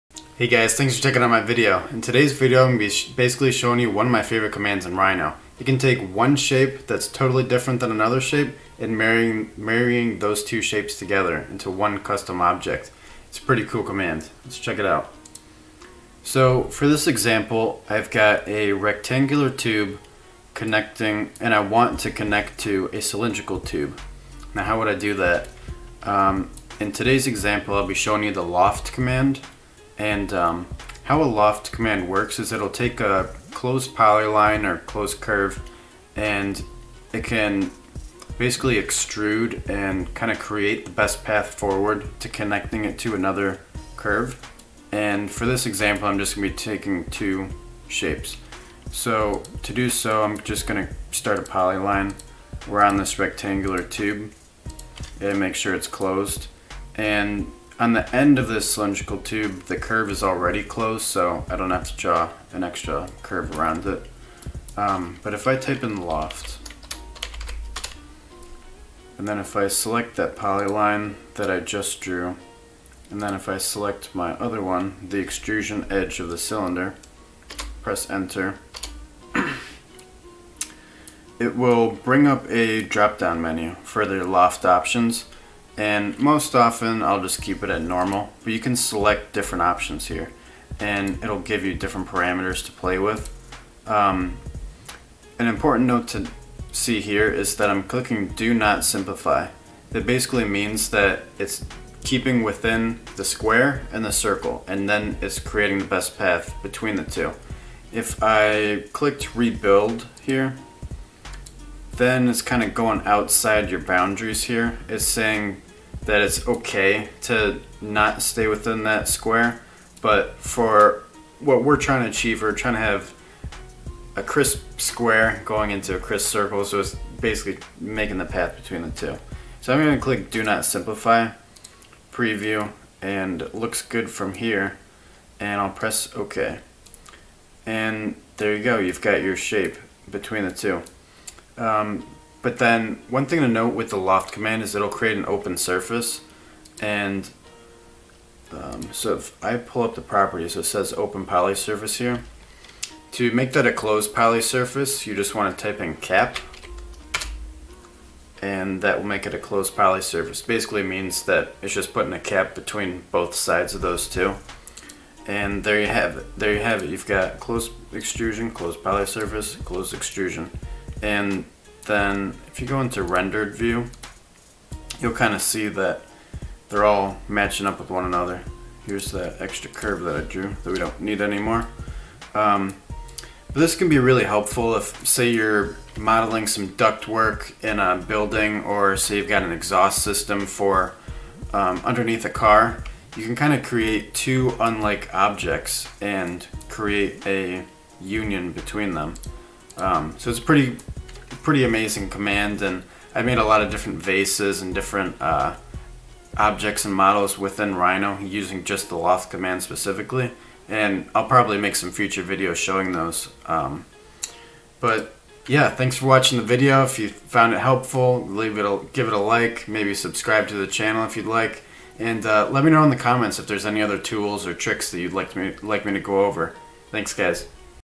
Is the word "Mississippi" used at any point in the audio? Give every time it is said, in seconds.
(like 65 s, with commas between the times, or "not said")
not said.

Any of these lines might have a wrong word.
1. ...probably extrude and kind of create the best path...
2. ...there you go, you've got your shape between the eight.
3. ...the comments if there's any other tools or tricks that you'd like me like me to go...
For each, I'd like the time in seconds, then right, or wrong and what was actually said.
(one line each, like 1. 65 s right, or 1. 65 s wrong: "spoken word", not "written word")
1. 38 s wrong: "basically", not "probably"
2. 138 s wrong: "two", not "eight"
3. 222 s right.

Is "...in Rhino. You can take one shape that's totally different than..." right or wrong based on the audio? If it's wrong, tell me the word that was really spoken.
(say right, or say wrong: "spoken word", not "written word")
right.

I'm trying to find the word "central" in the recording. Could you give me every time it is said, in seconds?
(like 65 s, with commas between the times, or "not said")
not said.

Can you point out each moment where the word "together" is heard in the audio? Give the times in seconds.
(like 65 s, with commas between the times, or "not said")
10 s.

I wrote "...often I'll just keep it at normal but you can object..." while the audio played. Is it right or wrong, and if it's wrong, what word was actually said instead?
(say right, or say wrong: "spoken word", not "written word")
wrong: "select", not "object".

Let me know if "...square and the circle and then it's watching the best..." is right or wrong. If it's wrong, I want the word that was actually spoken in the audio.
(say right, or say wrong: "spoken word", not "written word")
wrong: "creating", not "watching".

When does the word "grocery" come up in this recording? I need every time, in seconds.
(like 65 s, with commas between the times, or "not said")
not said.